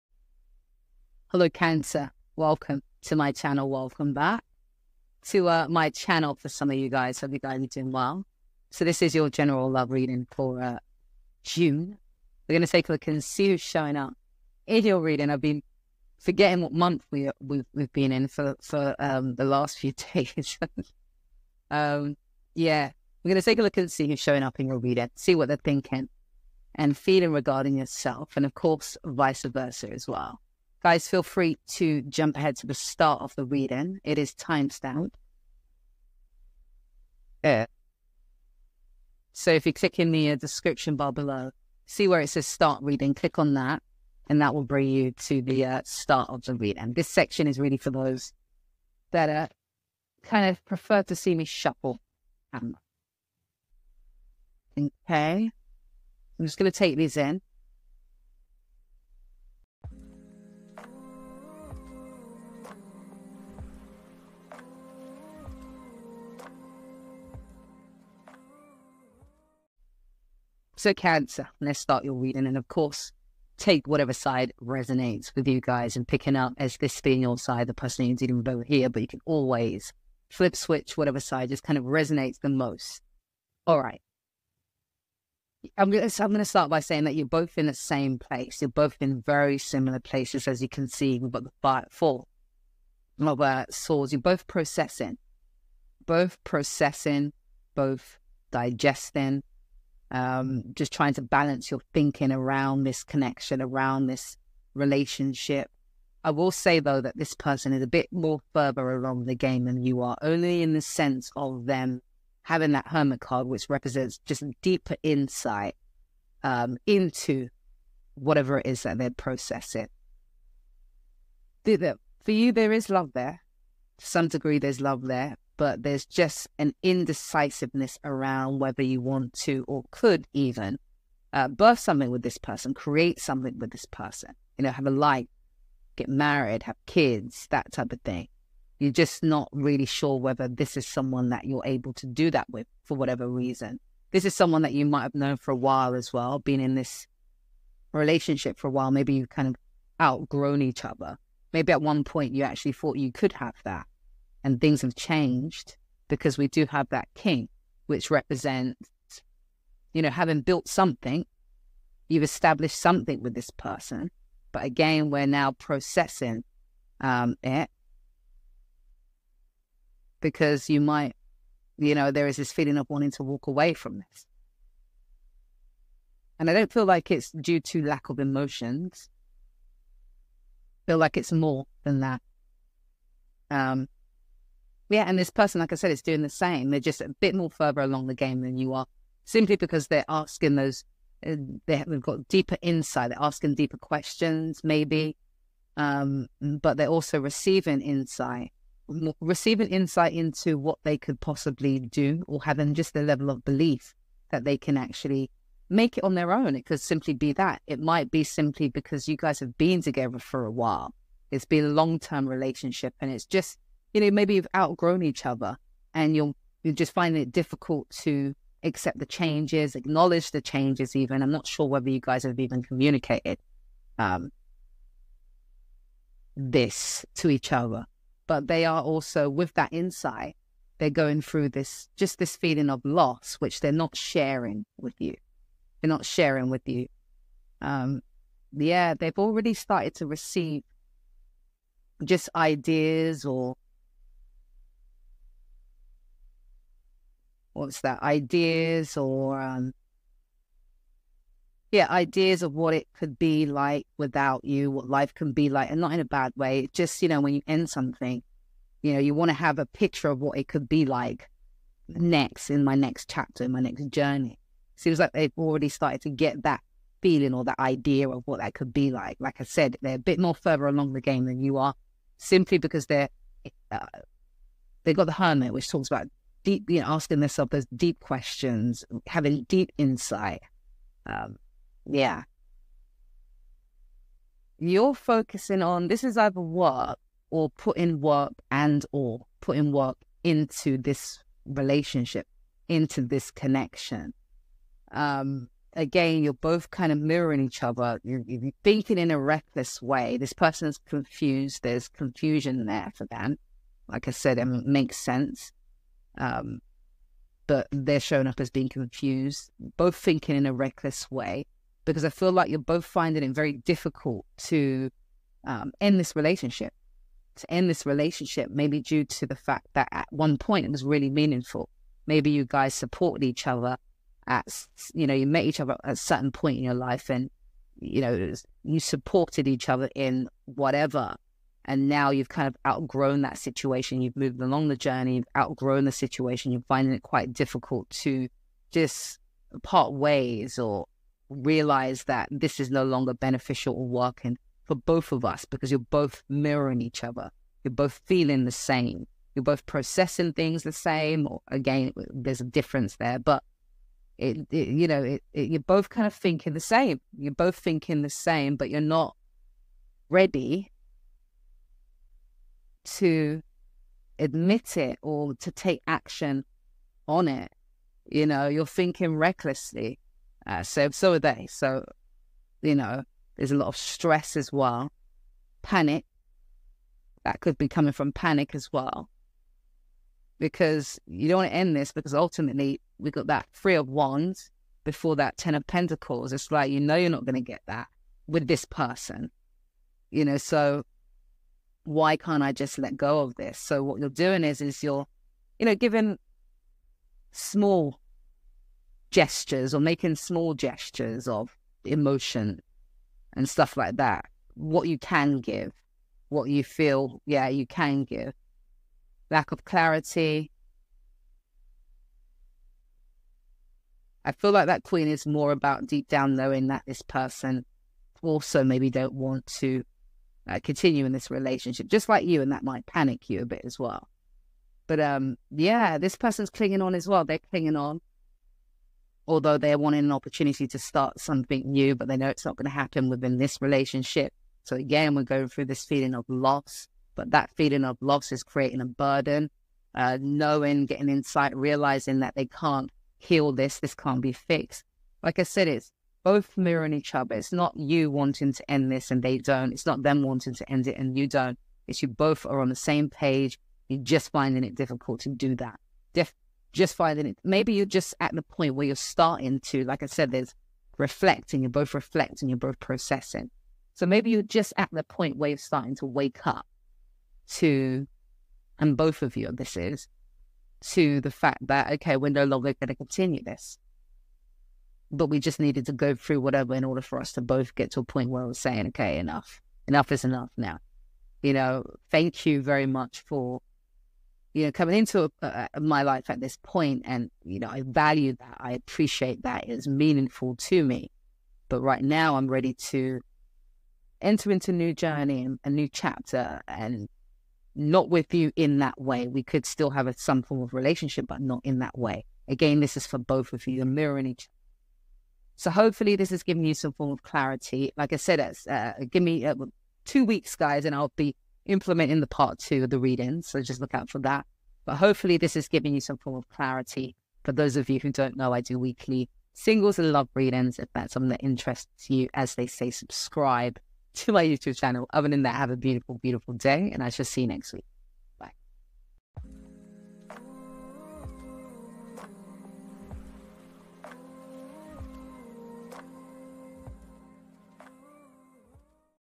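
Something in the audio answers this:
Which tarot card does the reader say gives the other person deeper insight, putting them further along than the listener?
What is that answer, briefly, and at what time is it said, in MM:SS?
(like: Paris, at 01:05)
The Hermit, at 01:52.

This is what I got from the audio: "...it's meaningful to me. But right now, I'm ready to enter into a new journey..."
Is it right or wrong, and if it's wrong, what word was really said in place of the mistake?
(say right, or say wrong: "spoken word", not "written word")
right.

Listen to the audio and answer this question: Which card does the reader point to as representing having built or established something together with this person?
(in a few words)
King.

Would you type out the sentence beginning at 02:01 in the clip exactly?
For you, there is love there.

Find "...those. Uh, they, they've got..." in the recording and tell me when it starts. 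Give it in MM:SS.
03:10.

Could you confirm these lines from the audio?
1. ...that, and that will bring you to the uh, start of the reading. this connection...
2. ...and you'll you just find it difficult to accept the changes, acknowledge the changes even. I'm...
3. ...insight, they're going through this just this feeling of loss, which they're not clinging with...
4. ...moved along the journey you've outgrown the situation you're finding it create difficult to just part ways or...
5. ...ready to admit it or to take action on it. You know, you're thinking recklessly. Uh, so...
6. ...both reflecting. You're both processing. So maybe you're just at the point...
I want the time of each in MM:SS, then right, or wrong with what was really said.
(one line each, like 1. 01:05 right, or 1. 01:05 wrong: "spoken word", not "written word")
1. 00:43 wrong: "section", not "connection"
2. 03:35 right
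3. 03:49 wrong: "sharing", not "clinging"
4. 05:34 wrong: "quite", not "create"
5. 06:00 right
6. 07:41 right.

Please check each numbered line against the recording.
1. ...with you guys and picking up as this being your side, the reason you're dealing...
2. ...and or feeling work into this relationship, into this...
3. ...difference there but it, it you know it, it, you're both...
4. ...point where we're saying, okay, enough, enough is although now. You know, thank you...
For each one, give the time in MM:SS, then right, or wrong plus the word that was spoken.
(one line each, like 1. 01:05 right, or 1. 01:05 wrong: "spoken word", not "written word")
1. 01:15 wrong: "person", not "reason"
2. 04:48 wrong: "putting", not "feeling"
3. 05:52 right
4. 07:58 wrong: "enough", not "although".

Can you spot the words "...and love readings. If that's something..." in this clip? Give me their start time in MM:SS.
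08:39.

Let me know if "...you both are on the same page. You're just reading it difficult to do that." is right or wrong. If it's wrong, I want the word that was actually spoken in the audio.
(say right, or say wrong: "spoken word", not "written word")
wrong: "finding", not "reading".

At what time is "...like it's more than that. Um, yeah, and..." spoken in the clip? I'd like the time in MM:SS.
03:00.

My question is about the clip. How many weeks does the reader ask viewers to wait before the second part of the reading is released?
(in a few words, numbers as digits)
2.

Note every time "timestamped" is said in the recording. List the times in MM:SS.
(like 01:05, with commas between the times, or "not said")
00:34.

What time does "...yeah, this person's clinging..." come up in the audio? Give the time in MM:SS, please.
07:05.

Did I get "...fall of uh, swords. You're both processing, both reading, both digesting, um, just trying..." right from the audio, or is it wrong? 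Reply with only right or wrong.
wrong.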